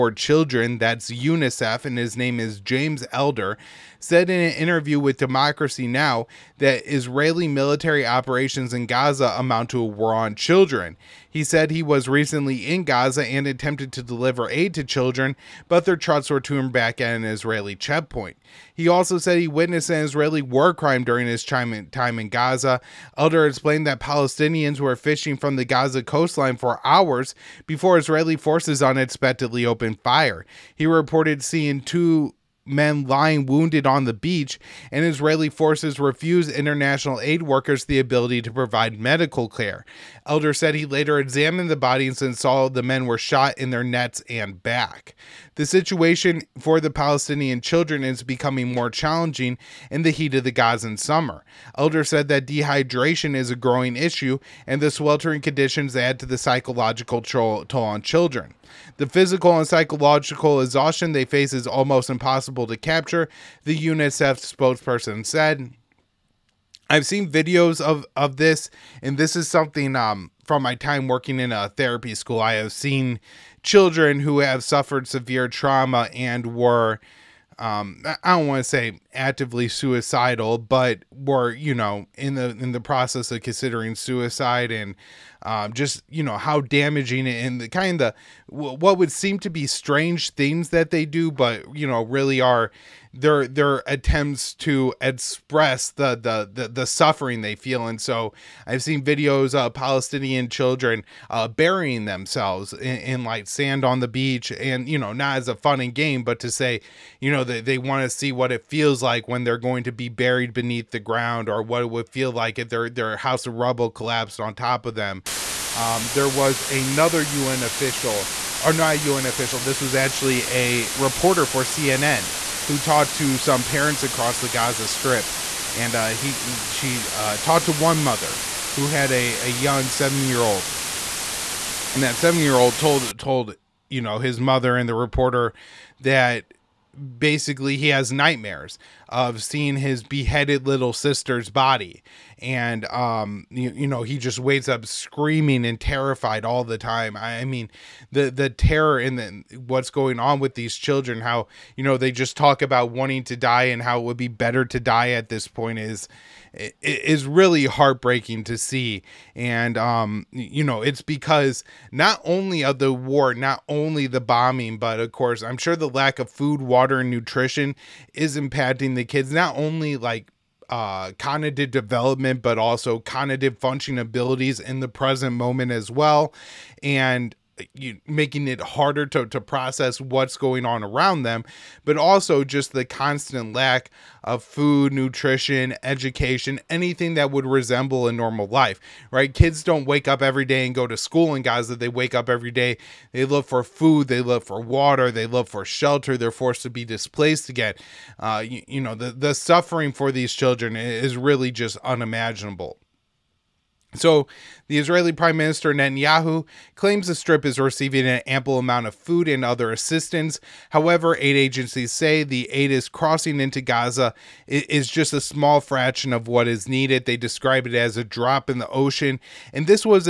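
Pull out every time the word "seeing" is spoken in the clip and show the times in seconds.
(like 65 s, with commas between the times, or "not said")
31 s, 139 s.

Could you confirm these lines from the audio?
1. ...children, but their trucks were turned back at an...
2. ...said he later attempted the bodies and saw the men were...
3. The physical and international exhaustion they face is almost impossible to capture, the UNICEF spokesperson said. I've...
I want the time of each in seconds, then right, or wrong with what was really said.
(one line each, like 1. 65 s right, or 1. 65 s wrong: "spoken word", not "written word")
1. 14 s right
2. 40 s wrong: "examined", not "attempted"
3. 58 s wrong: "psychological", not "international".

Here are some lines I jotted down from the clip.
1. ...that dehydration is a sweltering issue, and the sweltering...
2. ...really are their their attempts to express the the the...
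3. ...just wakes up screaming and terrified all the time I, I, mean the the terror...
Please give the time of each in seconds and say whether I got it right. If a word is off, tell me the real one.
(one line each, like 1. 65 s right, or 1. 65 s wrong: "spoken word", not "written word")
1. 52 s wrong: "growing", not "sweltering"
2. 92 s right
3. 144 s right.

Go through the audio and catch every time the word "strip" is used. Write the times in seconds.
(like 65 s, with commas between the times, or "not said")
124 s, 207 s.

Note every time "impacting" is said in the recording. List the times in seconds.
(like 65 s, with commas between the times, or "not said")
168 s.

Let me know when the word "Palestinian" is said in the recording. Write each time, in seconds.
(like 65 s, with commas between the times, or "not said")
23 s, 46 s, 99 s.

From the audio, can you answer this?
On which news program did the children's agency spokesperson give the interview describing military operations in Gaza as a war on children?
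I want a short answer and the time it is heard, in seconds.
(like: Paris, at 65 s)
Democracy Now!, at 5 s.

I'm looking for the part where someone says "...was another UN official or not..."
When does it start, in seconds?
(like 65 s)
116 s.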